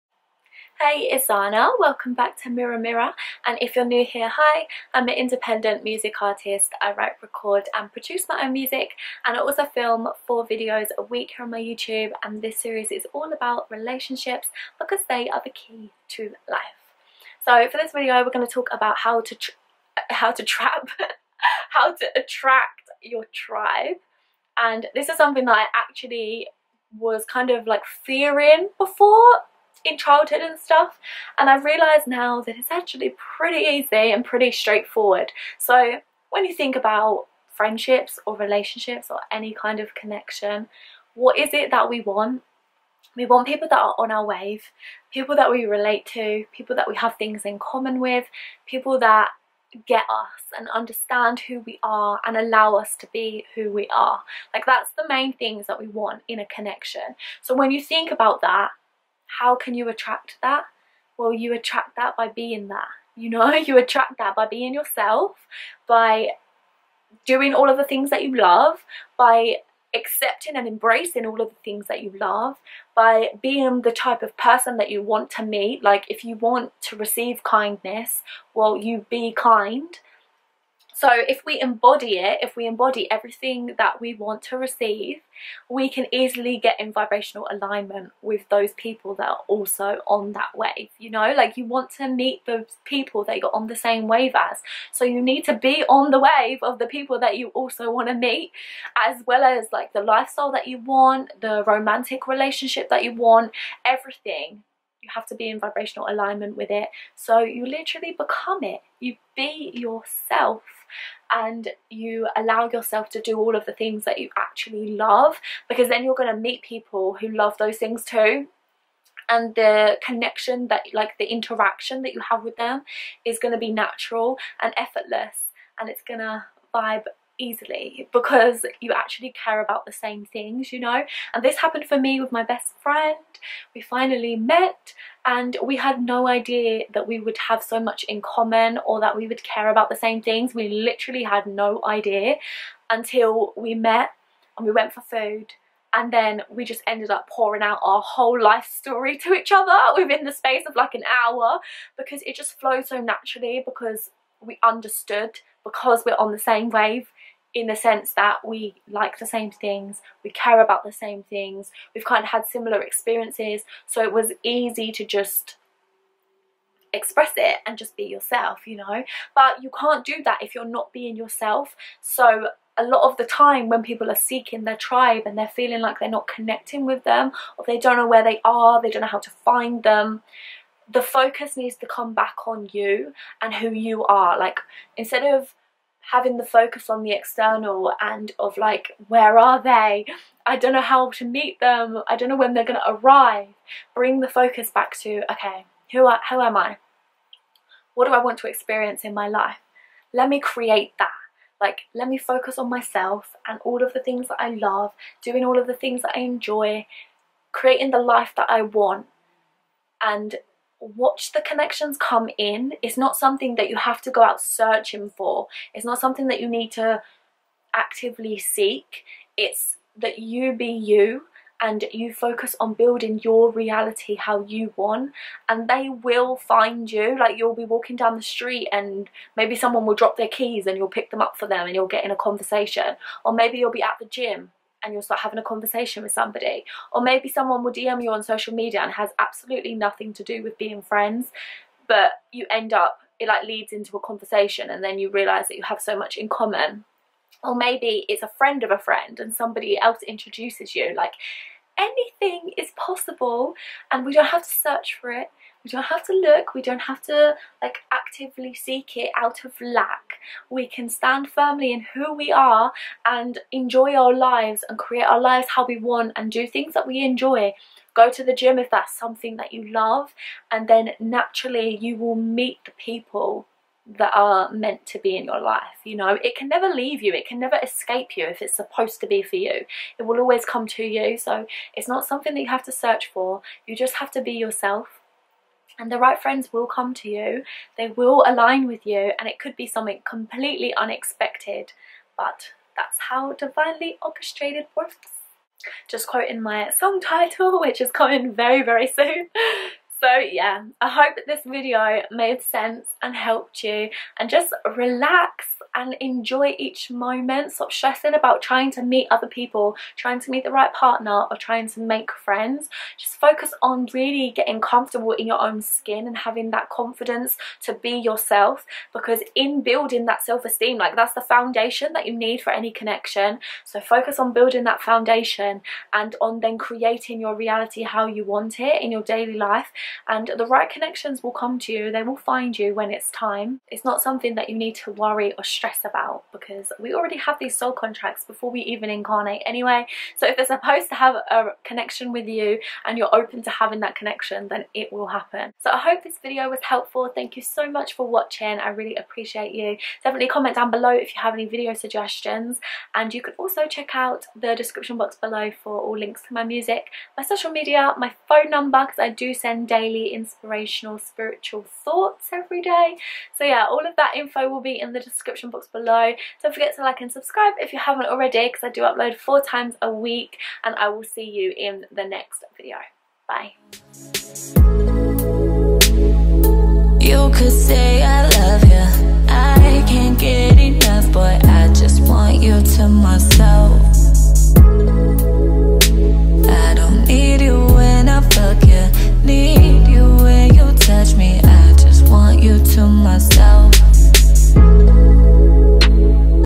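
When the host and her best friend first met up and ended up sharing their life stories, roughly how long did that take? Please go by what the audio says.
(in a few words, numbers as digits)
an hour.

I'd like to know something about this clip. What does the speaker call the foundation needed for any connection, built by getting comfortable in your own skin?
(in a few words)
self esteem.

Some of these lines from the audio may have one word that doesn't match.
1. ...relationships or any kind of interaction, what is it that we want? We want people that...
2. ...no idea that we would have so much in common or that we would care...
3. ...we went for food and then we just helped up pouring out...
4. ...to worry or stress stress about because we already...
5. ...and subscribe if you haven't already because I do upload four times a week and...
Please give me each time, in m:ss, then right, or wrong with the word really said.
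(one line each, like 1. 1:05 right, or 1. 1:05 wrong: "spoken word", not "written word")
1. 0:38 wrong: "connection", not "interaction"
2. 2:16 right
3. 2:24 wrong: "ended", not "helped"
4. 5:34 right
5. 6:07 right.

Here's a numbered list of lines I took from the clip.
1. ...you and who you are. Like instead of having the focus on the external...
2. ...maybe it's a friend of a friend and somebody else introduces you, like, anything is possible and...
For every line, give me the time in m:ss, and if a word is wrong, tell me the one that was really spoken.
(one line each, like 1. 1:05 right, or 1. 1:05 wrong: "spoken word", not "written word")
1. 3:02 right
2. 4:07 right.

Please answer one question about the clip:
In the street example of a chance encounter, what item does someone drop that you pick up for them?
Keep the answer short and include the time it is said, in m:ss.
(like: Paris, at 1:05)
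keys, at 3:50.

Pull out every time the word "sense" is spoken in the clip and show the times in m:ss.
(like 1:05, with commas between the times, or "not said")
2:37, 5:02.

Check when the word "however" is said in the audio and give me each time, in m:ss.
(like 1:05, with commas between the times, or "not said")
not said.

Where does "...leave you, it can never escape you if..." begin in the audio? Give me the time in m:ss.
4:36.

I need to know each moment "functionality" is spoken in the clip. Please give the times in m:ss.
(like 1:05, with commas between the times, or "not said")
not said.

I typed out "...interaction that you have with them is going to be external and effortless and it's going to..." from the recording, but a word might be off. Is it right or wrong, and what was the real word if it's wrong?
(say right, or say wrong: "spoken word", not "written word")
wrong: "natural", not "external".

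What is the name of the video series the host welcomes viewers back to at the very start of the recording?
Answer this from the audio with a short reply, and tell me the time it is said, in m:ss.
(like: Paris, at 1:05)
Mirror Mirror, at 0:02.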